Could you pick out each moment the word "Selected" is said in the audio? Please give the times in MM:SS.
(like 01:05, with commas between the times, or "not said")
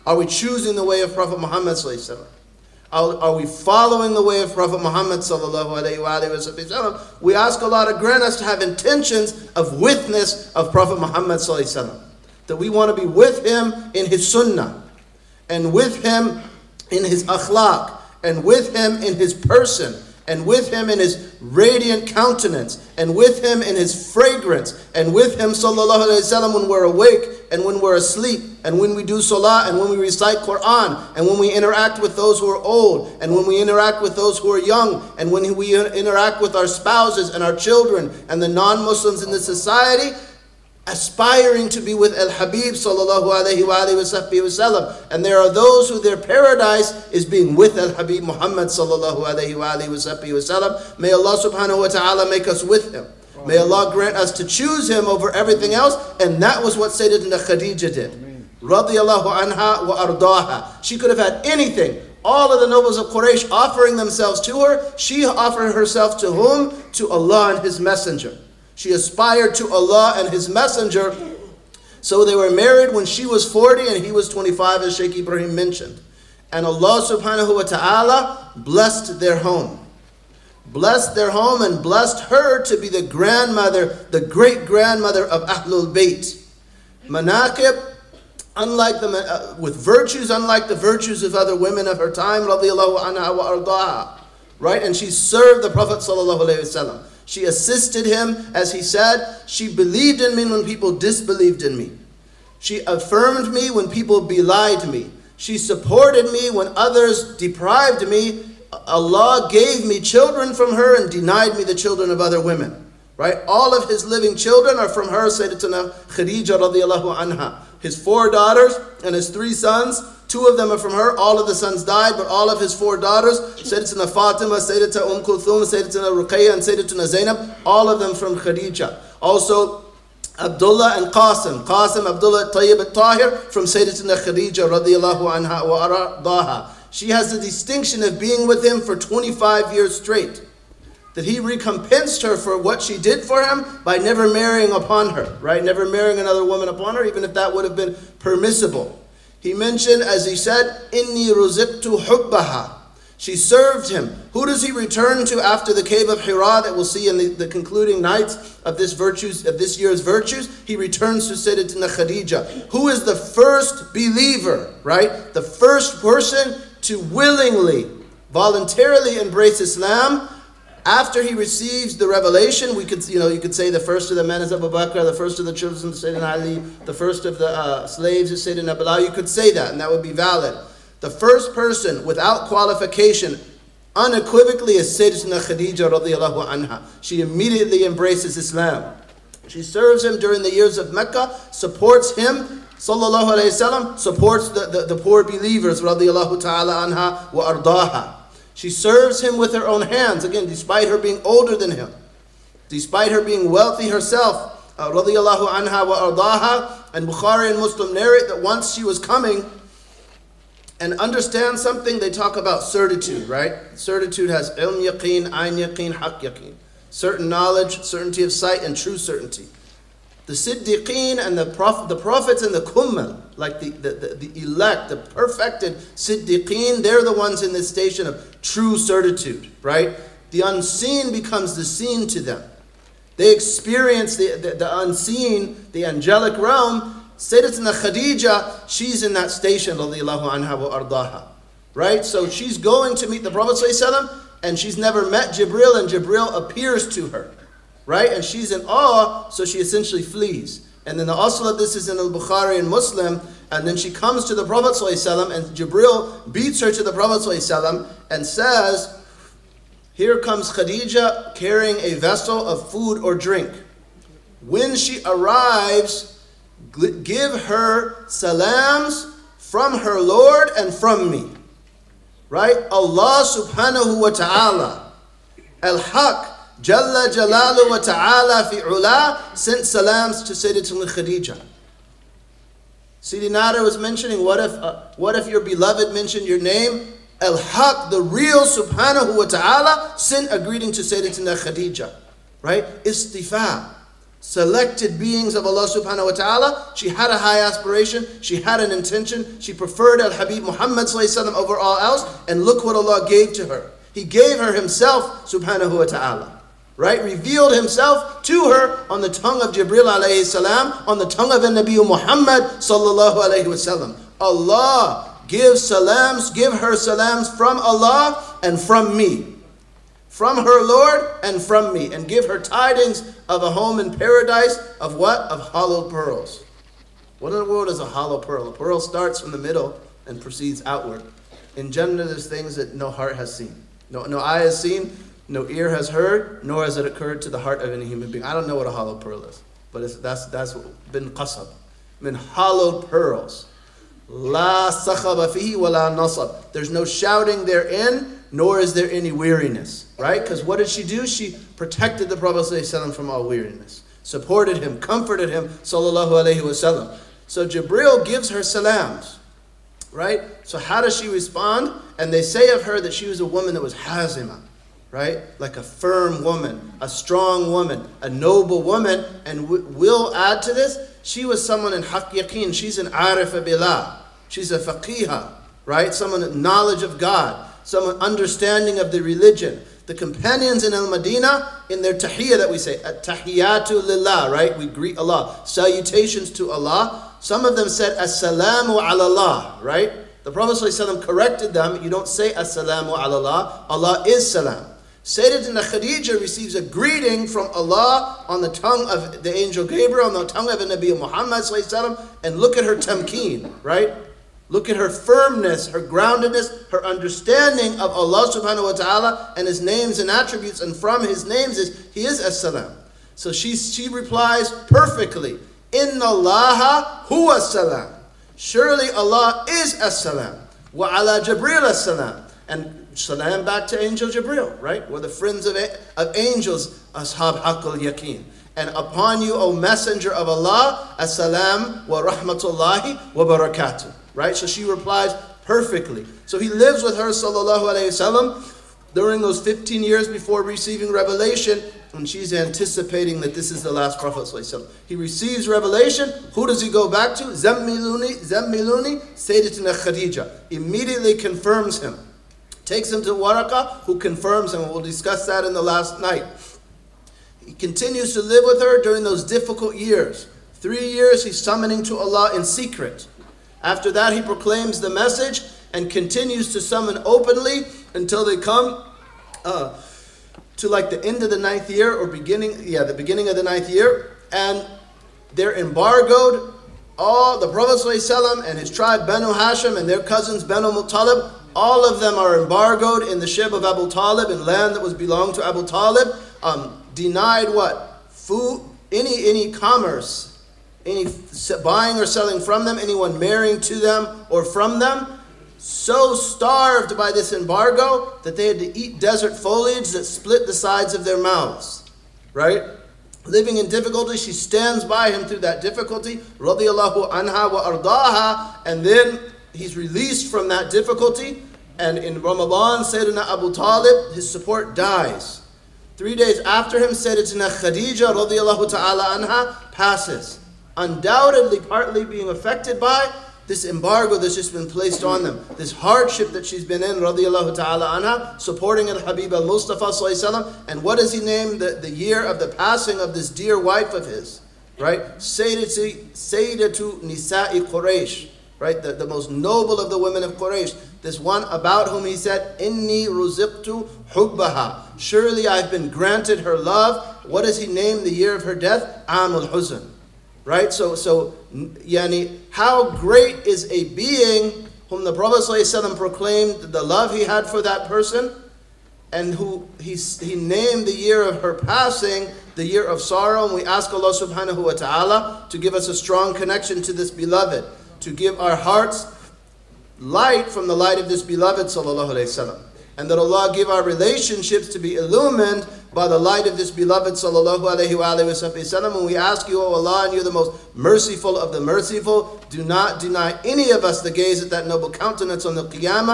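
04:54.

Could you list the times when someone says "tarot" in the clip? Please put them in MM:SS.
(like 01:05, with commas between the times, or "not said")
not said.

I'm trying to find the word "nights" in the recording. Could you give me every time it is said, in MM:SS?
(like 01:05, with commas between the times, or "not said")
02:38, 07:36.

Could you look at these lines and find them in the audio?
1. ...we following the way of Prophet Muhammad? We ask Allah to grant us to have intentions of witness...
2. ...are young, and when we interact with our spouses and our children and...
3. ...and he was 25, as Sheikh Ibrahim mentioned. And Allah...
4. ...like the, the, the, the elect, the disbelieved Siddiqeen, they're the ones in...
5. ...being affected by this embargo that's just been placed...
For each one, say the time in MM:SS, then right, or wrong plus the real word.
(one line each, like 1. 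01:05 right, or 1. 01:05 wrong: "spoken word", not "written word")
1. 00:03 right
2. 00:34 right
3. 01:13 right
4. 03:43 wrong: "perfected", not "disbelieved"
5. 08:42 right.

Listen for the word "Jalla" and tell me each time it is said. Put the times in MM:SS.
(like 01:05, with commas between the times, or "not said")
04:36.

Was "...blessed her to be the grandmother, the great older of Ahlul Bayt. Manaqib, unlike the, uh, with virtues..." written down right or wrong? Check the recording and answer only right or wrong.
wrong.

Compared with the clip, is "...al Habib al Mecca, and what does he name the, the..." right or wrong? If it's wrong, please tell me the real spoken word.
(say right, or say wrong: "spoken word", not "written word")
wrong: "Mustafa", not "Mecca".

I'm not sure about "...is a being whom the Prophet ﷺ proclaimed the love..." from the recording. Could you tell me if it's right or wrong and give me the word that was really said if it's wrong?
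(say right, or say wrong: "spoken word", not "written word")
right.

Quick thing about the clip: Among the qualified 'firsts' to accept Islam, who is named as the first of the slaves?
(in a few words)
Bilal.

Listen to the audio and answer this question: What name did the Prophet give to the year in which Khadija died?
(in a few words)
Amul Huzn.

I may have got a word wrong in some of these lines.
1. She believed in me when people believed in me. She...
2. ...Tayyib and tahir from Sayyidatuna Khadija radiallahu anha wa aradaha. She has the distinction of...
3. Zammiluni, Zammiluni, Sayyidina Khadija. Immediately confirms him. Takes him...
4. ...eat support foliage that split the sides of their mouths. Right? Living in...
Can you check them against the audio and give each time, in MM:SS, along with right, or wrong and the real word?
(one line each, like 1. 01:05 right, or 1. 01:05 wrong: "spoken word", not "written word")
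1. 01:39 wrong: "disbelieved", not "believed"
2. 02:12 right
3. 07:27 right
4. 08:18 wrong: "desert", not "support".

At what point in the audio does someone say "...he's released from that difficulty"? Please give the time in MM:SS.
08:29.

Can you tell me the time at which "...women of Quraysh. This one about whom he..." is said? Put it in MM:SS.
08:59.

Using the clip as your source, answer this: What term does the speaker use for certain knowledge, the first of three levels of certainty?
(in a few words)
ilm yaqeen.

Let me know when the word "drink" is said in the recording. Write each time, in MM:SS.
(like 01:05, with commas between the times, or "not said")
04:23.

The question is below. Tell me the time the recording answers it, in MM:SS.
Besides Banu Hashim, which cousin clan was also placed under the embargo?
08:00.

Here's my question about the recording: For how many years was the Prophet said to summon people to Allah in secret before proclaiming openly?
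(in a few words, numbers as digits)
3.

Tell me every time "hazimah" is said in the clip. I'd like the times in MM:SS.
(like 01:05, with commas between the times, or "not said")
06:03.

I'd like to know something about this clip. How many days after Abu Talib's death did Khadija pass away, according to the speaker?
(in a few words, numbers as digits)
3.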